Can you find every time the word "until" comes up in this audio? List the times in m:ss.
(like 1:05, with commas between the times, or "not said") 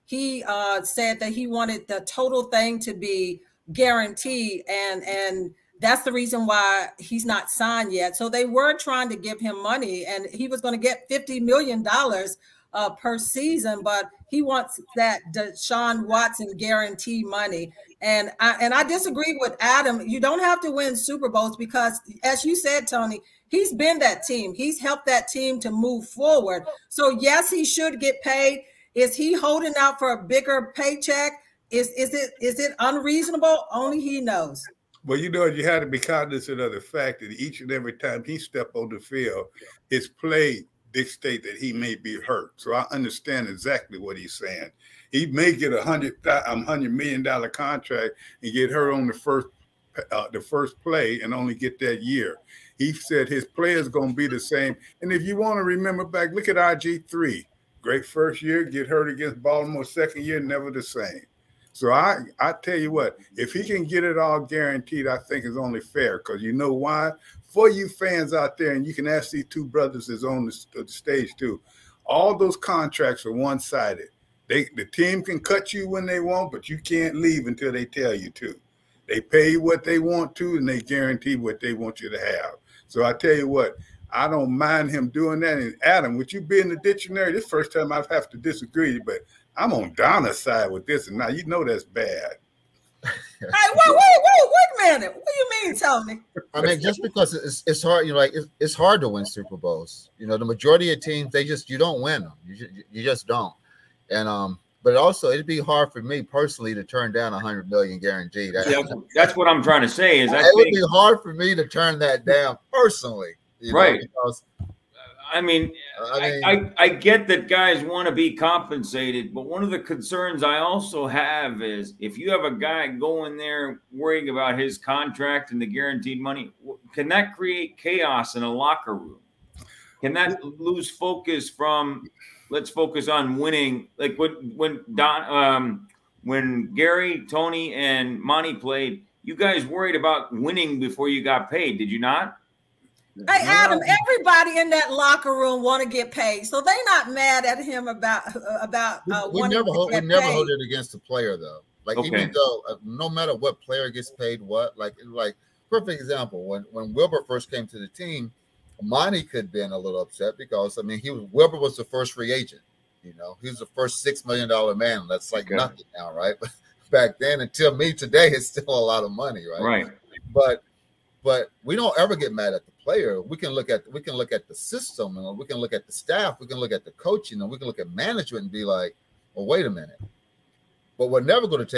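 1:17, 2:47.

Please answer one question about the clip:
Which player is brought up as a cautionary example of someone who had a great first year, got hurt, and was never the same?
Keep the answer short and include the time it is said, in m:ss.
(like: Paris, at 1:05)
RG3, at 0:56.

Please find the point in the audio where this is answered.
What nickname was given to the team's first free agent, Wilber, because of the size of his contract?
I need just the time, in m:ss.
2:44.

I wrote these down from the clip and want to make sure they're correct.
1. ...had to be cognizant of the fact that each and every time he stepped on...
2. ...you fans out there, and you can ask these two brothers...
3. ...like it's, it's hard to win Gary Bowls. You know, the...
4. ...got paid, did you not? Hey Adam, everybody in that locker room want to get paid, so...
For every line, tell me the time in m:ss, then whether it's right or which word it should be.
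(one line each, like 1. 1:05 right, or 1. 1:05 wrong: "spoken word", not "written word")
1. 0:35 right
2. 1:07 right
3. 1:38 wrong: "Super", not "Gary"
4. 2:21 right.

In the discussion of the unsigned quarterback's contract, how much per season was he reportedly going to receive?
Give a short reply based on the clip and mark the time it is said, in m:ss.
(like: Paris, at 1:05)
$50 million, at 0:11.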